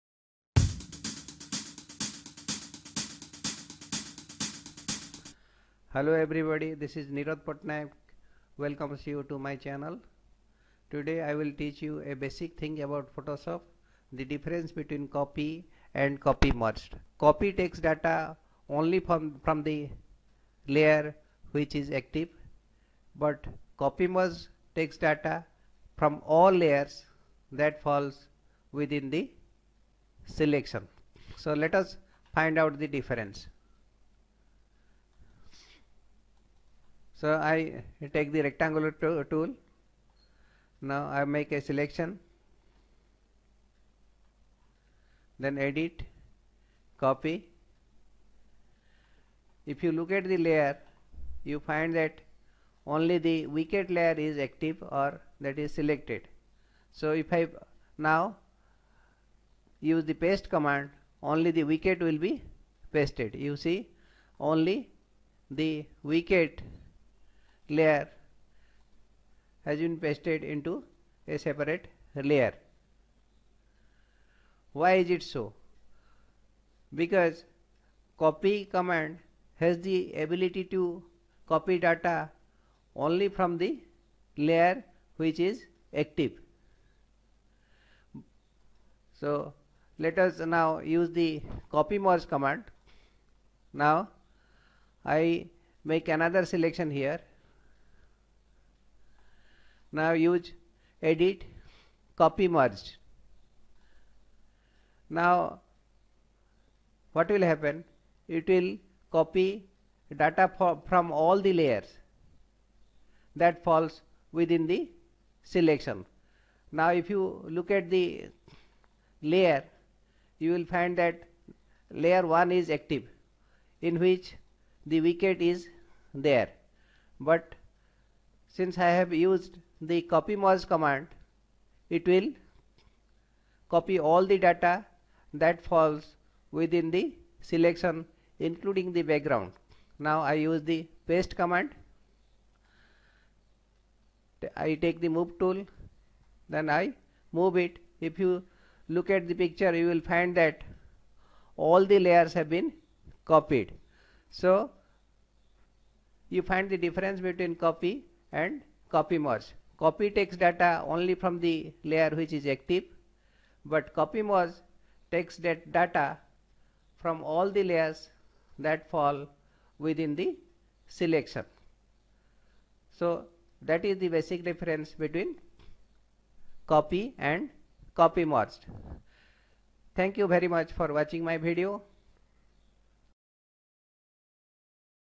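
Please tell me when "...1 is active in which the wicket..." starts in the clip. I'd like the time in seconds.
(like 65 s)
122 s.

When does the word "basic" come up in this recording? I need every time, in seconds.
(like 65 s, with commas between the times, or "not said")
12 s, 174 s.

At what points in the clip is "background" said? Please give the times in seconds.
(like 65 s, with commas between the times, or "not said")
139 s.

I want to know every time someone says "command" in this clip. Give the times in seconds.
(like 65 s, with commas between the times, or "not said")
60 s, 78 s, 92 s, 130 s, 141 s.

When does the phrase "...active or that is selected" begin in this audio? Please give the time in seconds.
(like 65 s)
54 s.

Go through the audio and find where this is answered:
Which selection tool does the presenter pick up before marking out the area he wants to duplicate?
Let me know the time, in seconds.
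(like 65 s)
38 s.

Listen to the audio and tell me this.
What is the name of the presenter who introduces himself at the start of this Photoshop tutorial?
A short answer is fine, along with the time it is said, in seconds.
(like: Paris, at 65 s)
Nirad Patnaik, at 7 s.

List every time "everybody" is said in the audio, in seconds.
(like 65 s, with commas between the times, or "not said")
6 s.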